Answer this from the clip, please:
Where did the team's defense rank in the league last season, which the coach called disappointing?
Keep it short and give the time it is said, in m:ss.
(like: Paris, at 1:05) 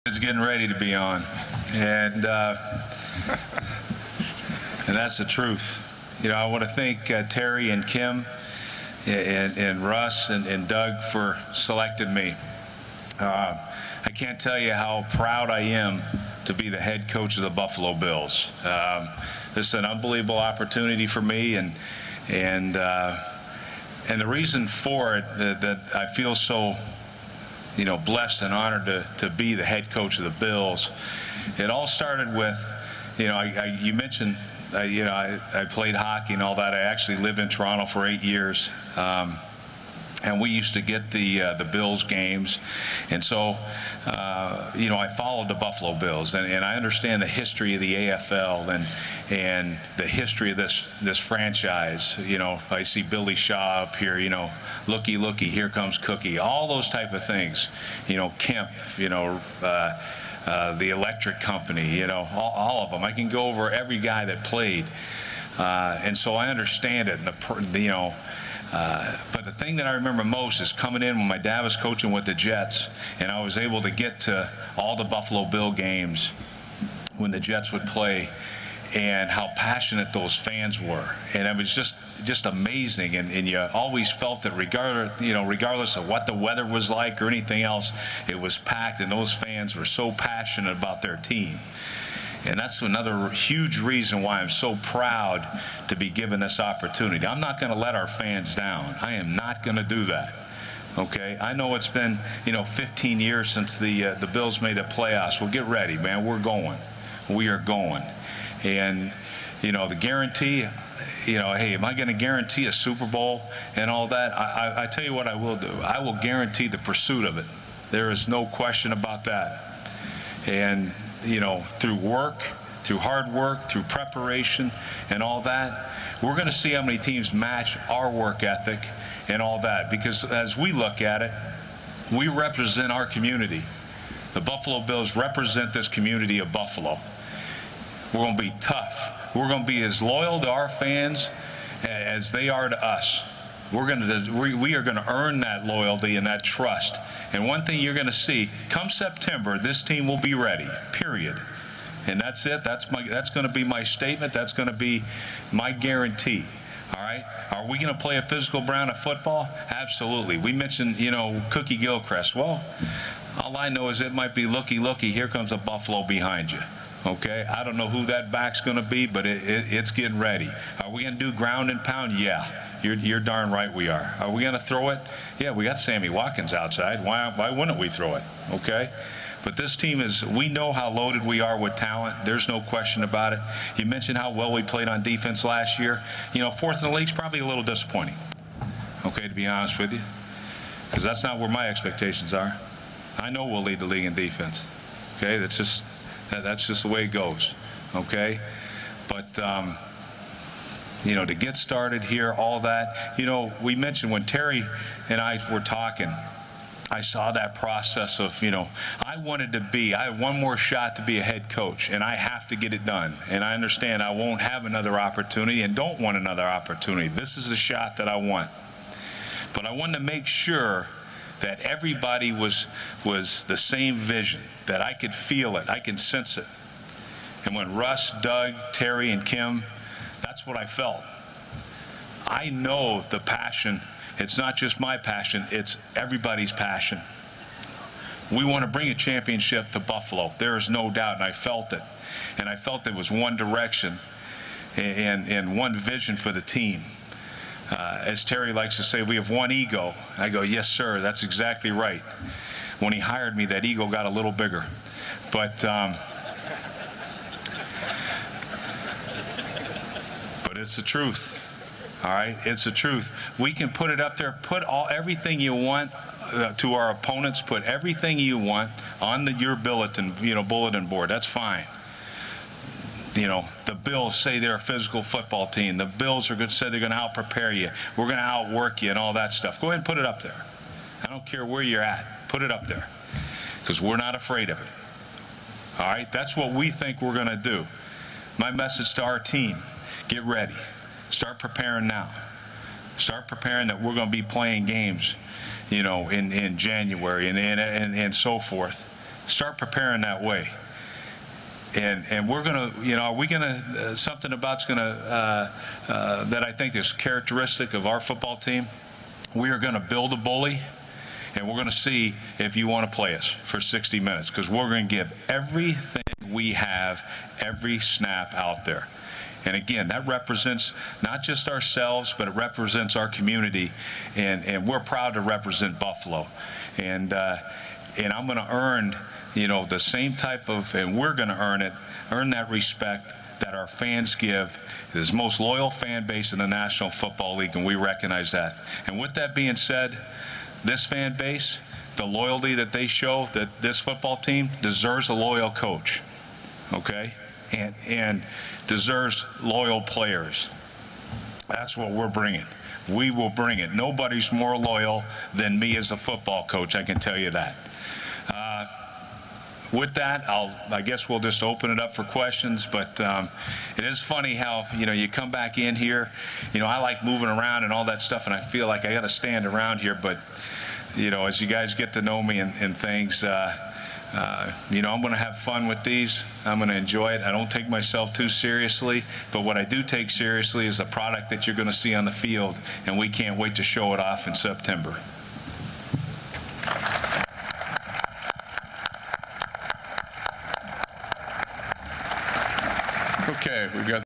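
Fourth, at 3:06.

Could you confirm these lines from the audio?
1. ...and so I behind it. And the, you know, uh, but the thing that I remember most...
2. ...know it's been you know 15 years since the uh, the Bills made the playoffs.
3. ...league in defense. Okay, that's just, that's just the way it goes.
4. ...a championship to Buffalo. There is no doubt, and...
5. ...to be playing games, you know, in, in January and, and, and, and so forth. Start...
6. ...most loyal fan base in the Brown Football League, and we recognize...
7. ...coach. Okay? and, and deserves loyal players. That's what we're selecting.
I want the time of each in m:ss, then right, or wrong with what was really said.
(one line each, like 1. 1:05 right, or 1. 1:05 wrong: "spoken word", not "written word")
1. 1:06 wrong: "understand", not "behind"
2. 1:41 right
3. 3:13 right
4. 3:58 right
5. 4:54 right
6. 5:35 wrong: "National", not "Brown"
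7. 5:45 wrong: "bringing", not "selecting".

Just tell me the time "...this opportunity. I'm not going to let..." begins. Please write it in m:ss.
1:36.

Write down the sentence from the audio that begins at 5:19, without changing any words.
And again, that represents not just ourselves, but it represents our community.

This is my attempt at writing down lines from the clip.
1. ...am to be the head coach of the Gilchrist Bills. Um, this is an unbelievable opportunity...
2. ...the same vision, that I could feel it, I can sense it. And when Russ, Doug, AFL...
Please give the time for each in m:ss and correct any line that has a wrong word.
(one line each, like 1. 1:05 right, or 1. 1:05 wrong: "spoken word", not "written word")
1. 0:15 wrong: "Buffalo", not "Gilchrist"
2. 3:43 wrong: "Terry", not "AFL".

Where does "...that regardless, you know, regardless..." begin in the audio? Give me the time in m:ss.
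1:24.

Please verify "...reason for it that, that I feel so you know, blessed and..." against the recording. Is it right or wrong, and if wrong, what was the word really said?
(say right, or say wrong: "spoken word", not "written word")
right.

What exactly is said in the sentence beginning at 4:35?
The Bills are going to say they're going to out prepare you.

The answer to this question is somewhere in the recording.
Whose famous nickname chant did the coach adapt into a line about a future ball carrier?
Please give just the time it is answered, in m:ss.
2:41.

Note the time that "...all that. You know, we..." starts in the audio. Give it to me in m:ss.
3:22.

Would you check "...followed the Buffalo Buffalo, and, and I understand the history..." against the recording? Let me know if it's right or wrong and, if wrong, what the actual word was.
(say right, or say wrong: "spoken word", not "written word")
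wrong: "Bills", not "Buffalo".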